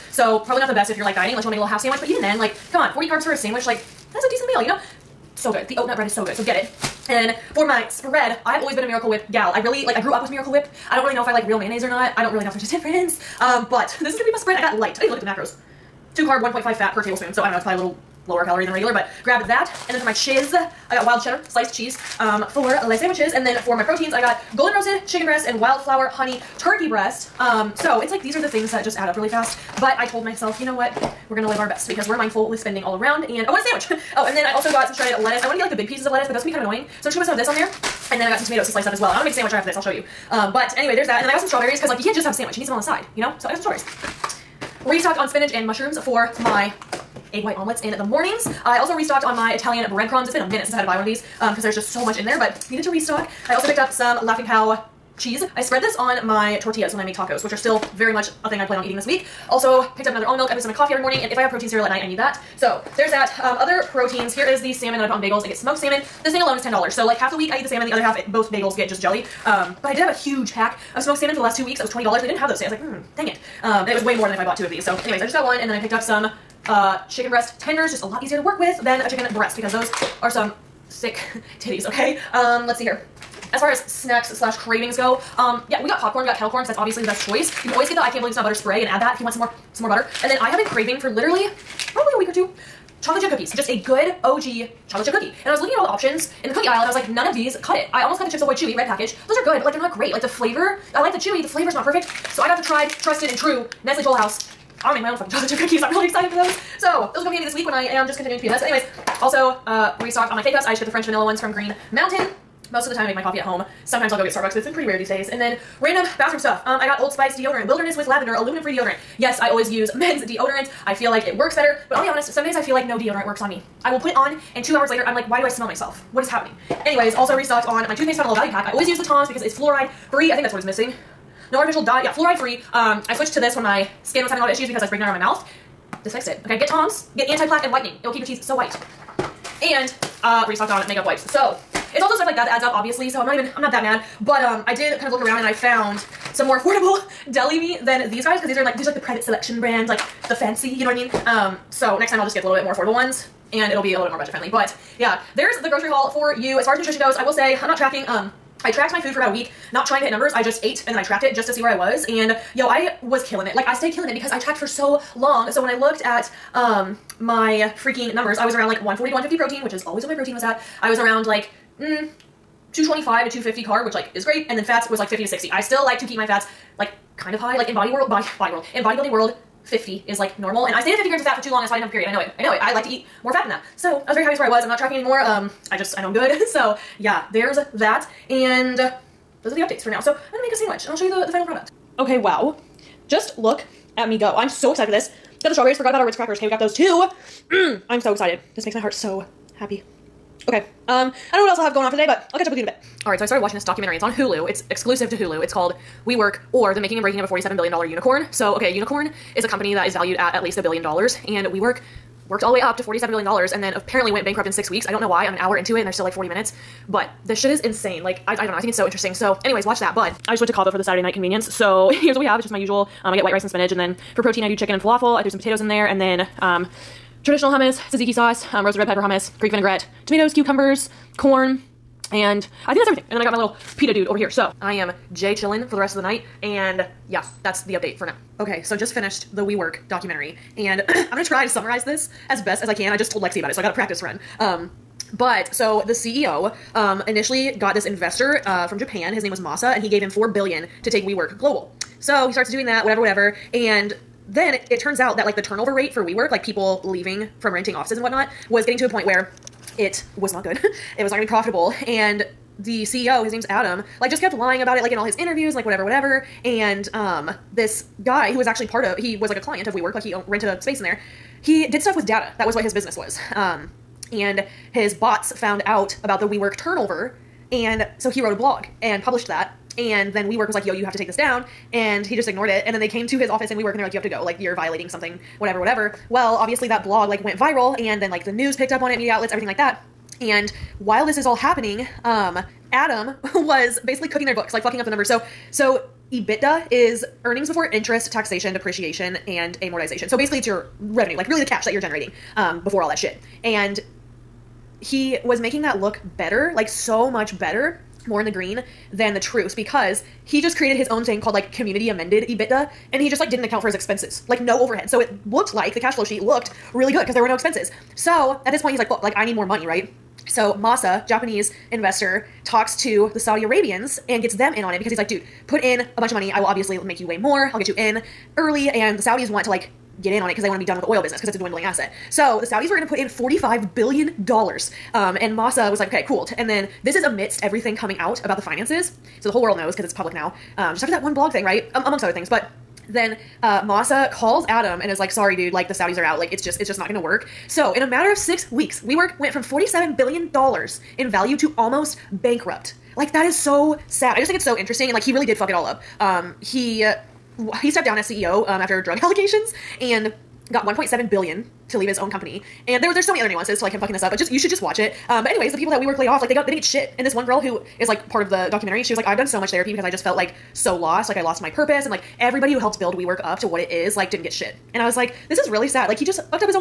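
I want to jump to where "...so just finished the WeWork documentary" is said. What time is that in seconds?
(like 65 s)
238 s.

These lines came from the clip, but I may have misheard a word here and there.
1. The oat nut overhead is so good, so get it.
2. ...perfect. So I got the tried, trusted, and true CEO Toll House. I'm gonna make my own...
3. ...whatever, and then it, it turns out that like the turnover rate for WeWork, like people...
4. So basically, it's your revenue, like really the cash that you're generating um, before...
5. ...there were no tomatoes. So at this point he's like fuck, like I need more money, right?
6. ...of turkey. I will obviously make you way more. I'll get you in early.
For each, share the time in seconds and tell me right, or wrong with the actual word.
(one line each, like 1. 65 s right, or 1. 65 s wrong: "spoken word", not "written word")
1. 5 s wrong: "bread", not "overhead"
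2. 101 s wrong: "Nestle", not "CEO"
3. 253 s right
4. 300 s right
5. 317 s wrong: "expenses", not "tomatoes"
6. 326 s wrong: "money", not "turkey".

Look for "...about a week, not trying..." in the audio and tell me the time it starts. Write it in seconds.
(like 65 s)
159 s.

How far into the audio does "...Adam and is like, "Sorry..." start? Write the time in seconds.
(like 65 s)
344 s.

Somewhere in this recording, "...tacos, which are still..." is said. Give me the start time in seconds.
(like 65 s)
57 s.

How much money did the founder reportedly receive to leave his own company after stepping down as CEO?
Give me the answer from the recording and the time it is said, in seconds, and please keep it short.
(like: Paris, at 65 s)
1.7 billion, at 360 s.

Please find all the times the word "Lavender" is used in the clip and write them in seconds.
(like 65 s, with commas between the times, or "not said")
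118 s.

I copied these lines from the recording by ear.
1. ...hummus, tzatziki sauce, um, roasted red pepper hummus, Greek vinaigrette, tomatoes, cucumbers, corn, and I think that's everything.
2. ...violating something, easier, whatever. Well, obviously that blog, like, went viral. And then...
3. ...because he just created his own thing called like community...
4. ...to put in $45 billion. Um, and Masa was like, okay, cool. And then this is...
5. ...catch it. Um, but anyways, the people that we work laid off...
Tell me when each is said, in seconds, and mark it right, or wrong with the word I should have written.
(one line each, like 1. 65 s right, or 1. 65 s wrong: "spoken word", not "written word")
1. 227 s right
2. 284 s wrong: "whatever", not "easier"
3. 309 s right
4. 332 s right
5. 364 s wrong: "watch", not "catch".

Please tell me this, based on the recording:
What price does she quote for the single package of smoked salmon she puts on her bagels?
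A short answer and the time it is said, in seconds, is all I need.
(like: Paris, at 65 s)
$10, at 66 s.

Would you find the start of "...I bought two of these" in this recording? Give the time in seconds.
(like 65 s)
74 s.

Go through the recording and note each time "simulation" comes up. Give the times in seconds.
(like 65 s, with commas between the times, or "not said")
not said.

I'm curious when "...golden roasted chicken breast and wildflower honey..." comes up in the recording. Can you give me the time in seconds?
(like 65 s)
24 s.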